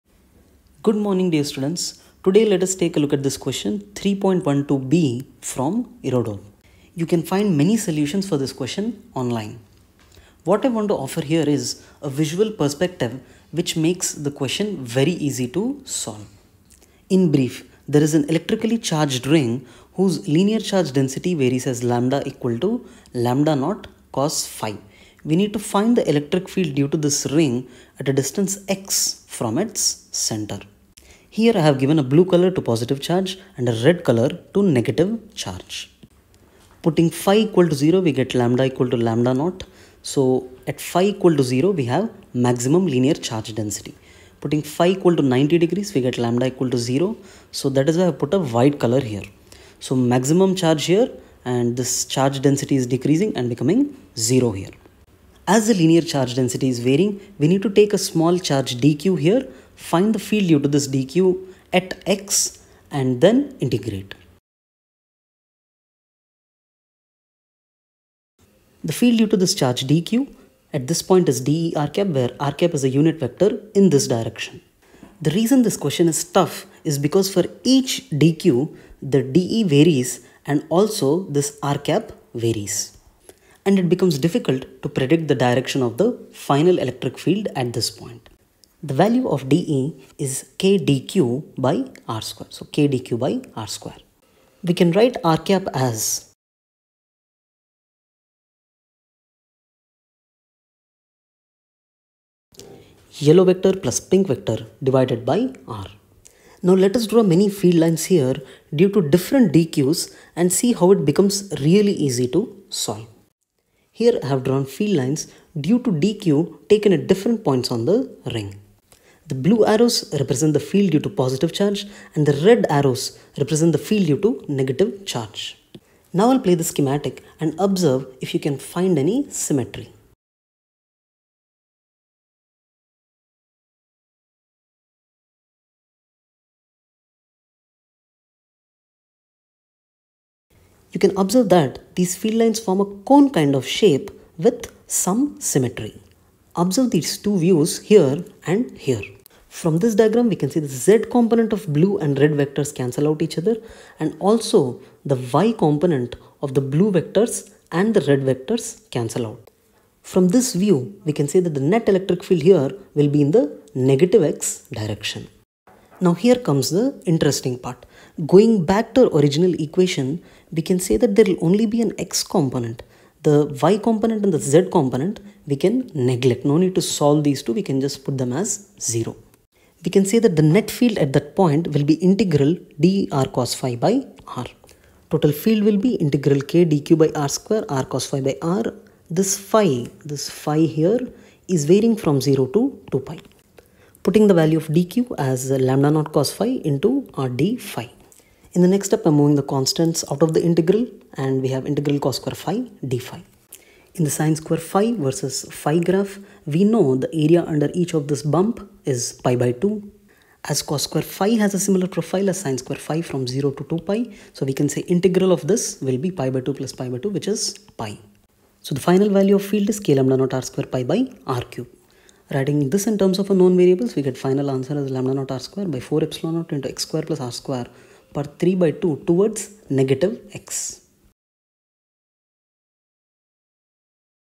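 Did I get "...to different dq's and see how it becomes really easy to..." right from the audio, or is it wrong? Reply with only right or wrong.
right.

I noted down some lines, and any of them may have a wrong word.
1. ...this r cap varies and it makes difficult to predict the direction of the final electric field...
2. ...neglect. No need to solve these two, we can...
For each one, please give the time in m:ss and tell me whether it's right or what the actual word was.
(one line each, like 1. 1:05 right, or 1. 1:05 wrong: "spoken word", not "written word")
1. 1:21 wrong: "becomes", not "makes"
2. 2:55 right.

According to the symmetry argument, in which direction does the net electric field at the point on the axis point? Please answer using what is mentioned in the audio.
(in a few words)
negative x direction.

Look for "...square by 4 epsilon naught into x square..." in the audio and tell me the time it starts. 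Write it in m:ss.
3:45.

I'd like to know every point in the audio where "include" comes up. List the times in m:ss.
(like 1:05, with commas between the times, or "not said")
not said.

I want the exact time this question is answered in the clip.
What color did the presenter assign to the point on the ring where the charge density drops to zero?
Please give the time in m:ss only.
0:48.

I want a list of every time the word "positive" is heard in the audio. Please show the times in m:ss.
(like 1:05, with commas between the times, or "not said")
0:32, 2:01.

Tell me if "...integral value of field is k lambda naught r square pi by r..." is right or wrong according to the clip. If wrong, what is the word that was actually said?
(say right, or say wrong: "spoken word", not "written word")
wrong: "final", not "integral".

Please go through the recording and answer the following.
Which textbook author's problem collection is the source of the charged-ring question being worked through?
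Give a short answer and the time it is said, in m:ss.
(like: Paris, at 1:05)
Irodov, at 0:06.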